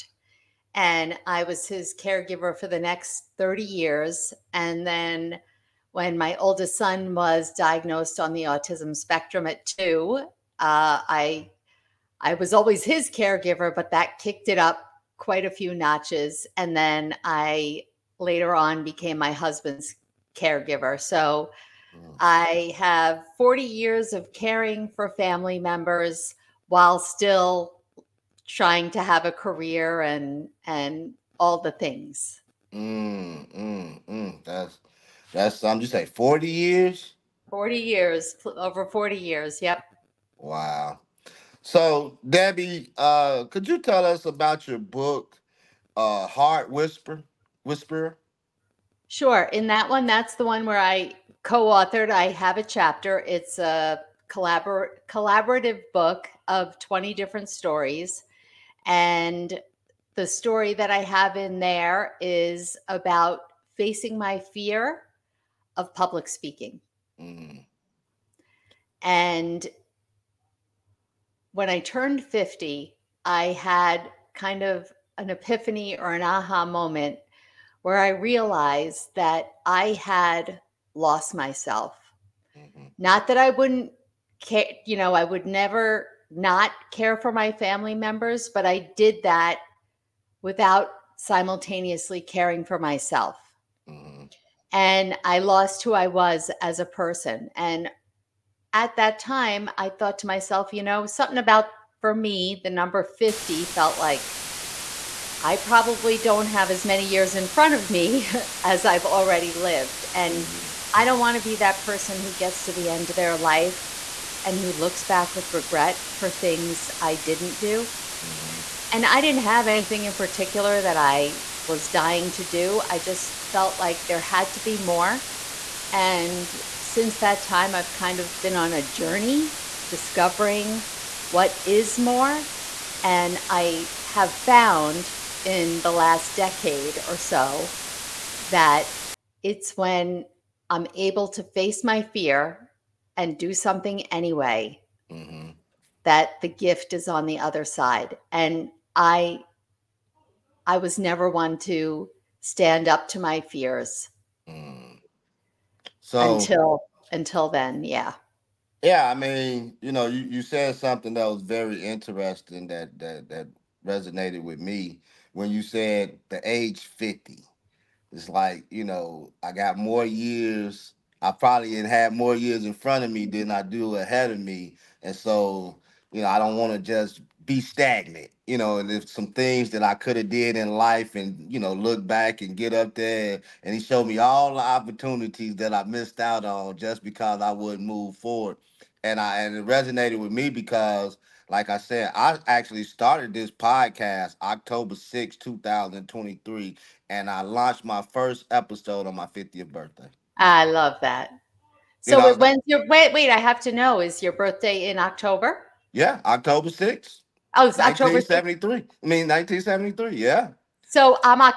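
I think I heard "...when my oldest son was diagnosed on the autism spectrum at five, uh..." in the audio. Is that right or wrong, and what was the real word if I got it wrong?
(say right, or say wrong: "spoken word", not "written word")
wrong: "two", not "five".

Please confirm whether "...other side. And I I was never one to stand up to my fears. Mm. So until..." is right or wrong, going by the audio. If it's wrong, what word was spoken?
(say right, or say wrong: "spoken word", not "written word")
right.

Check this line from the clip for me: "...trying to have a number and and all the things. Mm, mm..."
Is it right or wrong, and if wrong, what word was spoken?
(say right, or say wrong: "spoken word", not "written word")
wrong: "career", not "number".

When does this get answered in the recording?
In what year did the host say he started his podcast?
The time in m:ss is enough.
3:15.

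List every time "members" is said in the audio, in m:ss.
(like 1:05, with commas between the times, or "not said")
0:25, 1:27.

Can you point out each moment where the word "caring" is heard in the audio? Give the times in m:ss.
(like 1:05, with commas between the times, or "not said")
0:24, 1:32.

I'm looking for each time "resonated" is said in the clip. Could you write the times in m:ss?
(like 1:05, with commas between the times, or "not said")
2:43, 3:09.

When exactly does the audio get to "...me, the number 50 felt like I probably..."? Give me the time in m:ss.
1:42.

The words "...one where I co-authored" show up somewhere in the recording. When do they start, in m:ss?
0:50.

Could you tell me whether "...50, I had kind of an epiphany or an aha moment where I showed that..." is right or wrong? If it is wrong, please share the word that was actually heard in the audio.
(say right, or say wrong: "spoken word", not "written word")
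wrong: "realized", not "showed".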